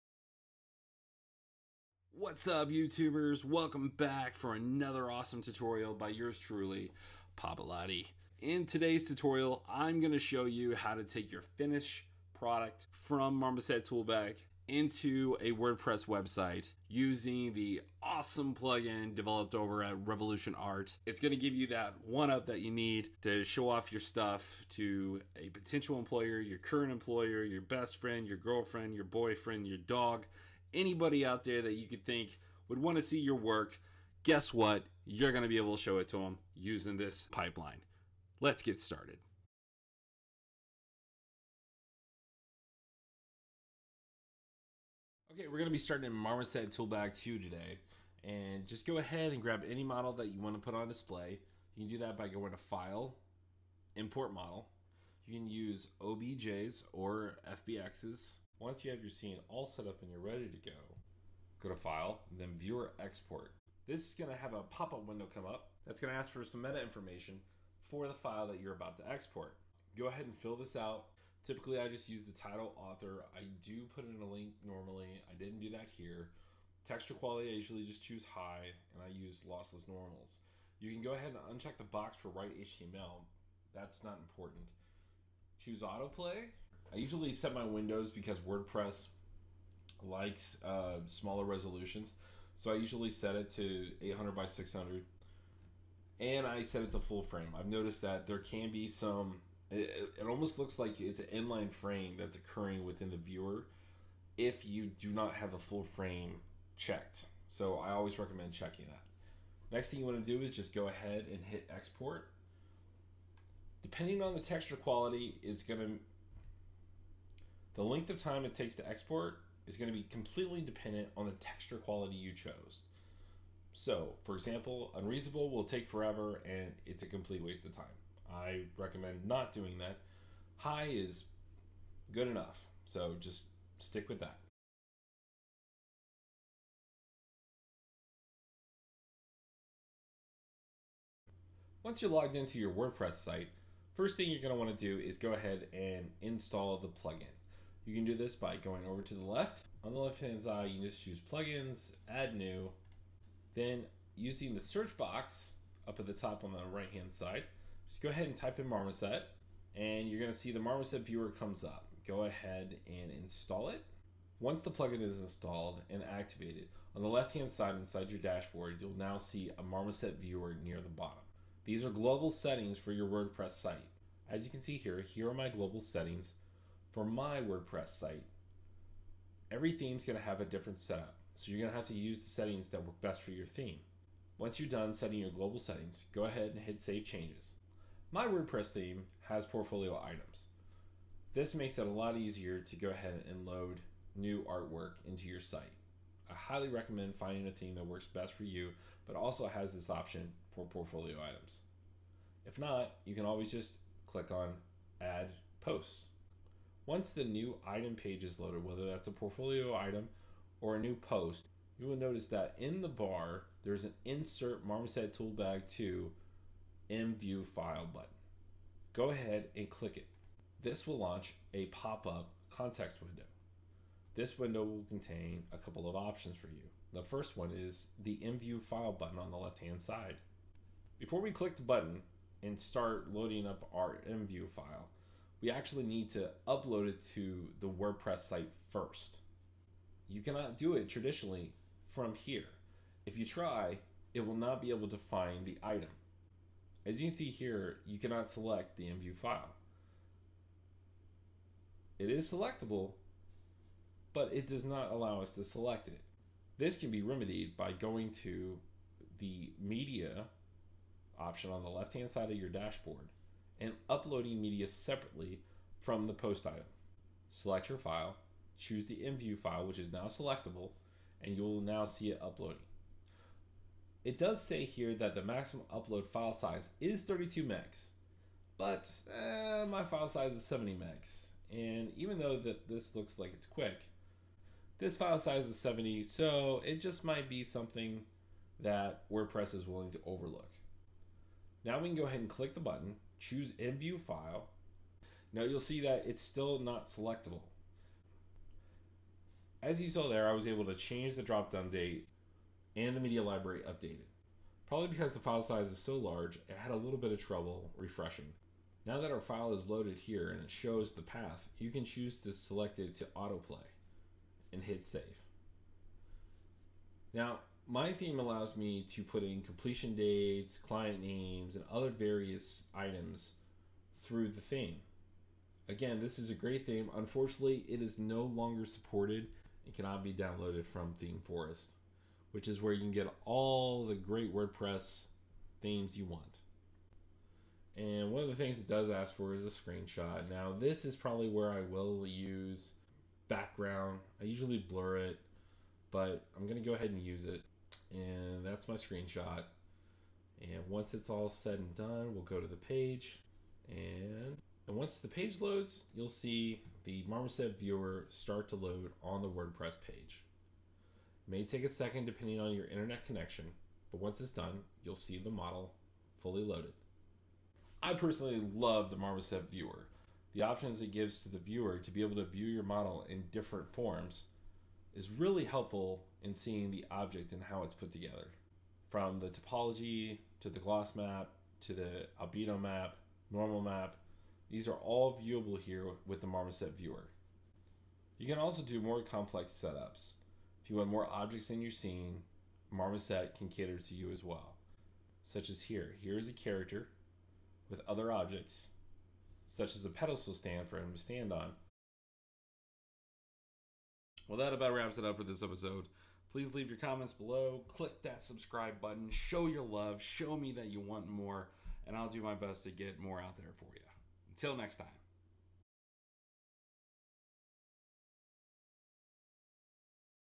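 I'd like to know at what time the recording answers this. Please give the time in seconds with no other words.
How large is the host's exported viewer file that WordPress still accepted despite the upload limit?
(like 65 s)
280 s.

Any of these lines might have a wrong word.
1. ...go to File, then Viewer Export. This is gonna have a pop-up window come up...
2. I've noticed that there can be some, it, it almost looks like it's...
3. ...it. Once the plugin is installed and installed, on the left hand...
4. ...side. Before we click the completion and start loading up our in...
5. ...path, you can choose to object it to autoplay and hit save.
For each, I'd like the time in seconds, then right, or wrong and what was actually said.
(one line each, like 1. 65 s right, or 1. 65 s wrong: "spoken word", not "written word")
1. 61 s right
2. 97 s right
3. 163 s wrong: "activated", not "installed"
4. 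229 s wrong: "button", not "completion"
5. 311 s wrong: "select", not "object".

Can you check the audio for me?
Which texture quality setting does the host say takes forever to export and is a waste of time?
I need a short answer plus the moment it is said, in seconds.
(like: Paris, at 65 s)
Unreasonable, at 124 s.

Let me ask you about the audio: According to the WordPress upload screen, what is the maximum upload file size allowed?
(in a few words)
32 megs.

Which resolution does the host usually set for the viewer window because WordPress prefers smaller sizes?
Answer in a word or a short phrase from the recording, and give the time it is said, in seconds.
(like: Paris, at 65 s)
800 by 600, at 94 s.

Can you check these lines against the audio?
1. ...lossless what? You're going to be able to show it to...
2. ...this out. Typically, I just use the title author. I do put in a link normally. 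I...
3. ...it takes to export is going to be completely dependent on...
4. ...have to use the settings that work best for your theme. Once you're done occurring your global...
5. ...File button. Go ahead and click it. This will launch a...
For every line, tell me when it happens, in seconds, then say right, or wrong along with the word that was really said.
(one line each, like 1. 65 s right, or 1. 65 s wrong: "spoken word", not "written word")
1. 34 s wrong: "guess", not "lossless"
2. 70 s right
3. 118 s right
4. 181 s wrong: "setting", not "occurring"
5. 217 s right.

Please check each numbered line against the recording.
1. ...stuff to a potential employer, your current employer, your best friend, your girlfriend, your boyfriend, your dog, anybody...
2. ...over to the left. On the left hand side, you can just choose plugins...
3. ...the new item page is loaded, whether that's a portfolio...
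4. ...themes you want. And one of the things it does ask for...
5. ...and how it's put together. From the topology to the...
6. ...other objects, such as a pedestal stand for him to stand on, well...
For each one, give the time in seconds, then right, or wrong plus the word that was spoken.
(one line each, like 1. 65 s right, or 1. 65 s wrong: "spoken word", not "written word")
1. 23 s right
2. 148 s right
3. 207 s right
4. 335 s right
5. 377 s right
6. 397 s right.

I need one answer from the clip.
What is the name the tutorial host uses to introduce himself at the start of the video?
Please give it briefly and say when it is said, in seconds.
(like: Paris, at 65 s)
Papalati, at 7 s.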